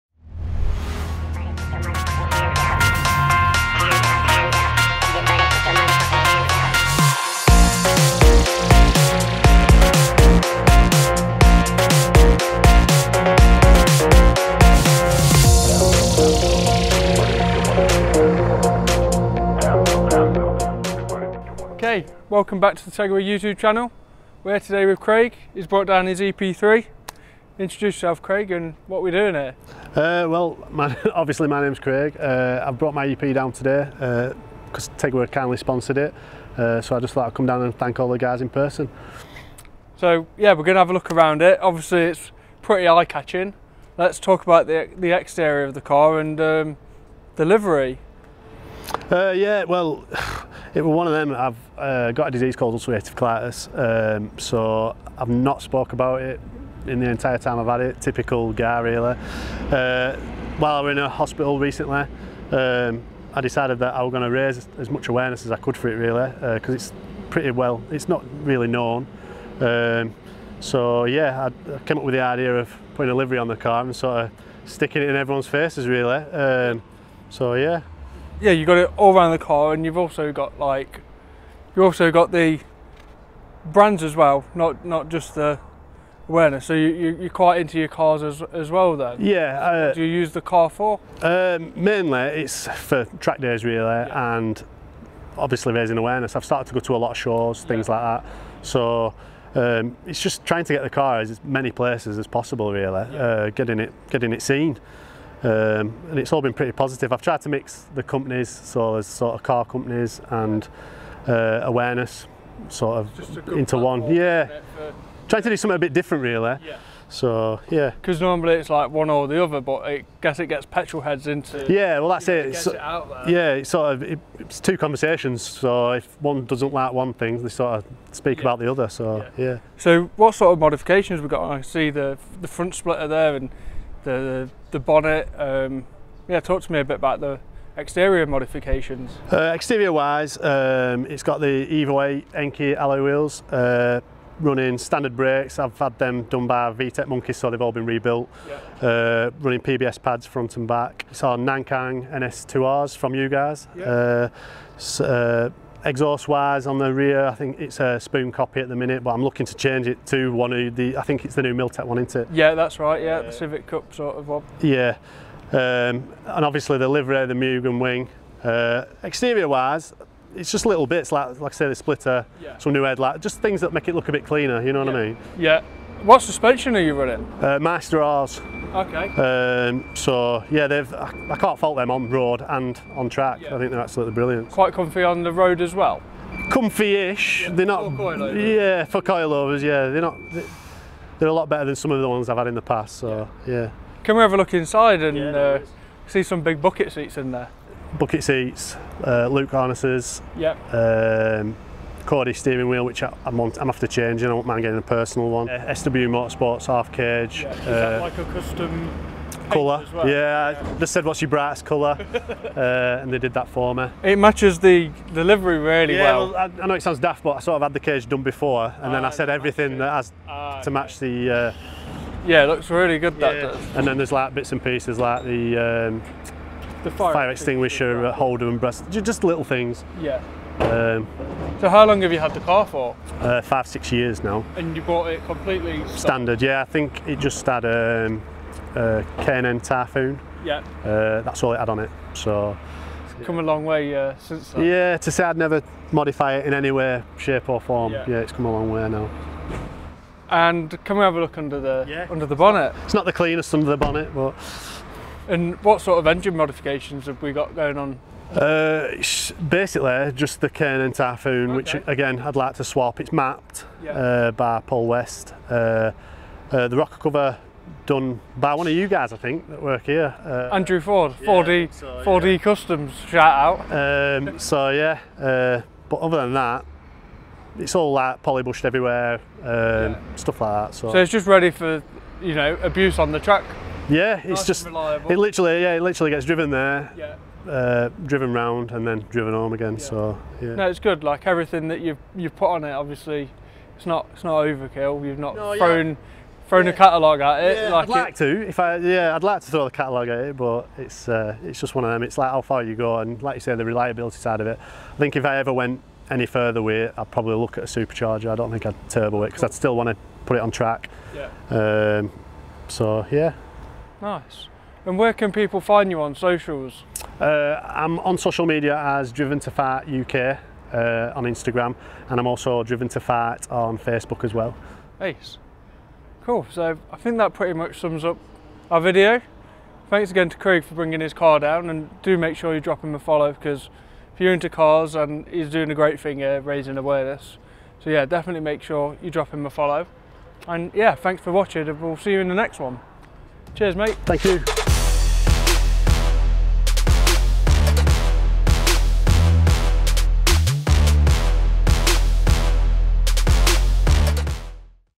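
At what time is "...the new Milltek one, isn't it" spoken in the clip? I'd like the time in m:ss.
2:41.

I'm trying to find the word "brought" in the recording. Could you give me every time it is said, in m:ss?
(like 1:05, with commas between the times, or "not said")
0:25, 0:32.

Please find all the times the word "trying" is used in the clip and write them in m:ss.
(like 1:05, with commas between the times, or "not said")
1:40, 1:55.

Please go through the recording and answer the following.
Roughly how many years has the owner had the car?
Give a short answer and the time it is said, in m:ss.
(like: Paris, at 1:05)
5 or 6 years, at 3:53.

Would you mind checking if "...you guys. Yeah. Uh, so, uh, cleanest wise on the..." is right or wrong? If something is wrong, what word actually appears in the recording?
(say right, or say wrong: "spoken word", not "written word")
wrong: "exhaust", not "cleanest".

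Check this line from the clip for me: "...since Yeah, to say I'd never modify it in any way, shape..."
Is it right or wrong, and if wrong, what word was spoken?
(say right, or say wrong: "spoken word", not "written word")
right.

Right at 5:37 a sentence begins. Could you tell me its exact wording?
So yeah, definitely make sure you drop him a follow.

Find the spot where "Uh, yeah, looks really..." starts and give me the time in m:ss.
3:41.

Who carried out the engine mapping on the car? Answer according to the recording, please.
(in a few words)
Paul West.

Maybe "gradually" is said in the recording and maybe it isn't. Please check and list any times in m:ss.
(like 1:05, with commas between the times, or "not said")
not said.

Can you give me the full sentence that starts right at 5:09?
I'd still want to put it on track.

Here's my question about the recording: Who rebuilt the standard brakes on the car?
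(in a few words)
VTEC Monkeys.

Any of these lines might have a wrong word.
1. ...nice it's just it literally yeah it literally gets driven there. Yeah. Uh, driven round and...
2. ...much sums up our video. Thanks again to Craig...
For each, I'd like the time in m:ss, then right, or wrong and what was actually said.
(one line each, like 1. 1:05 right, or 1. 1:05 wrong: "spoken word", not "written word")
1. 4:44 right
2. 5:27 right.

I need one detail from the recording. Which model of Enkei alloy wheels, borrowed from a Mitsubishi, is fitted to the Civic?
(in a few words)
Evo 8.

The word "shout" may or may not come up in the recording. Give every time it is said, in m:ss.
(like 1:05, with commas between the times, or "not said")
4:33.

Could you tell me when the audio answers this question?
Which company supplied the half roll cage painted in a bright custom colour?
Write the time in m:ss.
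3:25.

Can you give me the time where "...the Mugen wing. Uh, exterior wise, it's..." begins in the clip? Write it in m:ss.
2:47.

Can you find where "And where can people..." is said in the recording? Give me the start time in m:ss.
5:14.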